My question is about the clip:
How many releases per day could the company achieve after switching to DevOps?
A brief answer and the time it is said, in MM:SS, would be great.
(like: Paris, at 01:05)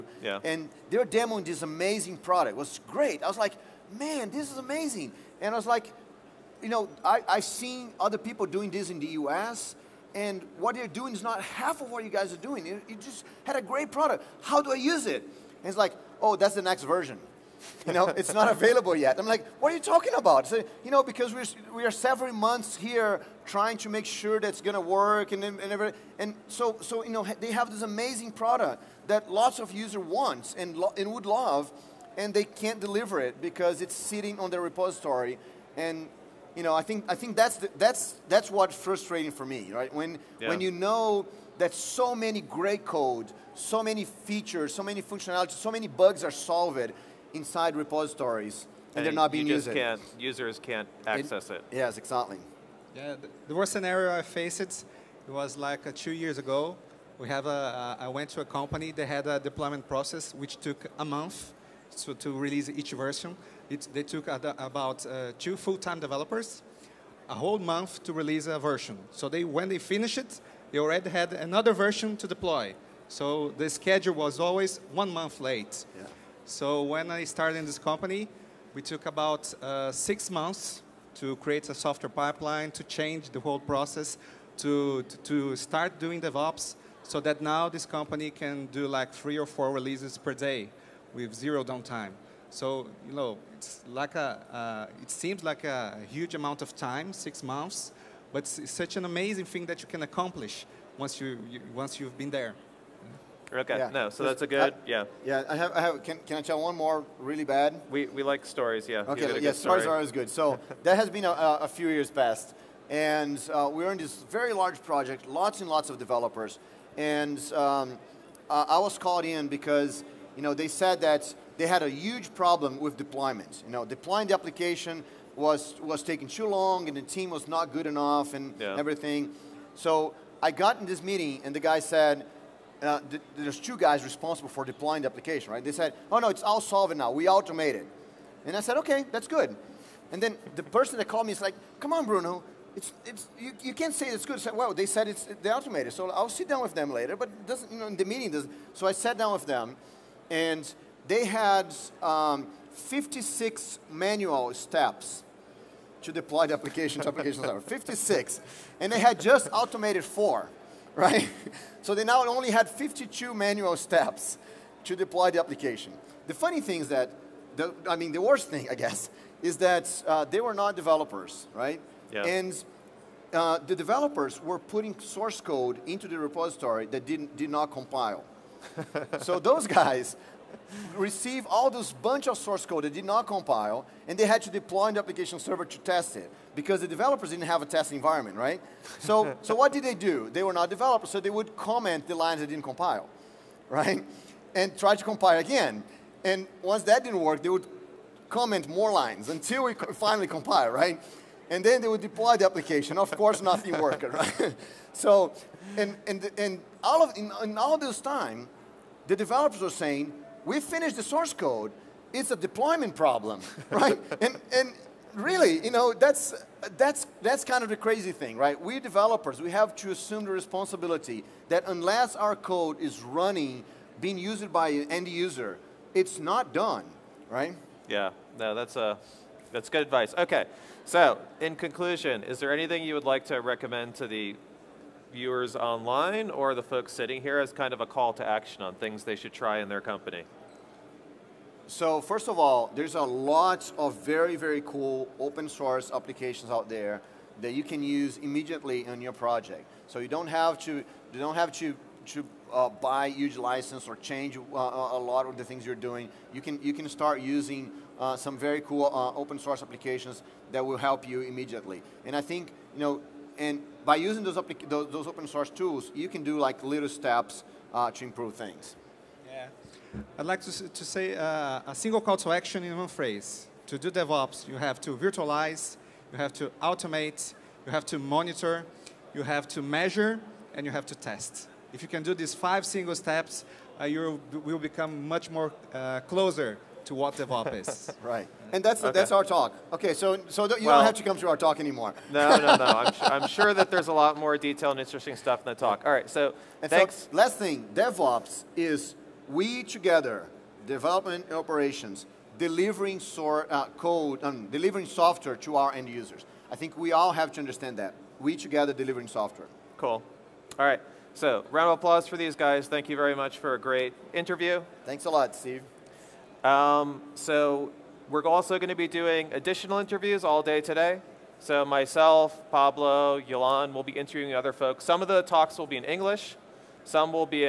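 3 or 4, at 01:29.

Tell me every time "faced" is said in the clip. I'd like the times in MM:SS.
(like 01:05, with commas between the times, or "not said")
00:54.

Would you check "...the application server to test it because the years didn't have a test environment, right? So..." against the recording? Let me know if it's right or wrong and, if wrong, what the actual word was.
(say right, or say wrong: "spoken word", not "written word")
wrong: "developers", not "years".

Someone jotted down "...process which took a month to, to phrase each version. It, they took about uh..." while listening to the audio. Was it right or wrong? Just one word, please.
wrong.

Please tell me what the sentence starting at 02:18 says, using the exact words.
And I said, okay, that's good.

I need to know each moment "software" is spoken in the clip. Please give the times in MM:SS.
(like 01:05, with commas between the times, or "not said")
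01:21, 05:04, 05:09.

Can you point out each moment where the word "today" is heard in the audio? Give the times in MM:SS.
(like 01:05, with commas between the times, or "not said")
05:20.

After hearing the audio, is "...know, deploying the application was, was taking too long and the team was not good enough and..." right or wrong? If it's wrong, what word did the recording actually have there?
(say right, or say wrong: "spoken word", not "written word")
right.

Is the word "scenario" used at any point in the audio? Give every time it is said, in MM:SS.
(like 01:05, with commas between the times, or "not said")
00:53.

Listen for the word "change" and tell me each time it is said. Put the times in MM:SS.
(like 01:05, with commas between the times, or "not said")
01:22, 04:13.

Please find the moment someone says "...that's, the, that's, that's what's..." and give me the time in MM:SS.
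00:37.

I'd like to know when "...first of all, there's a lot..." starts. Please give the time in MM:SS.
04:01.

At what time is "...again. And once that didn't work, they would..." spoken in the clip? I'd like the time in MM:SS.
03:15.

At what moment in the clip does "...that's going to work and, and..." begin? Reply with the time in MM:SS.
00:24.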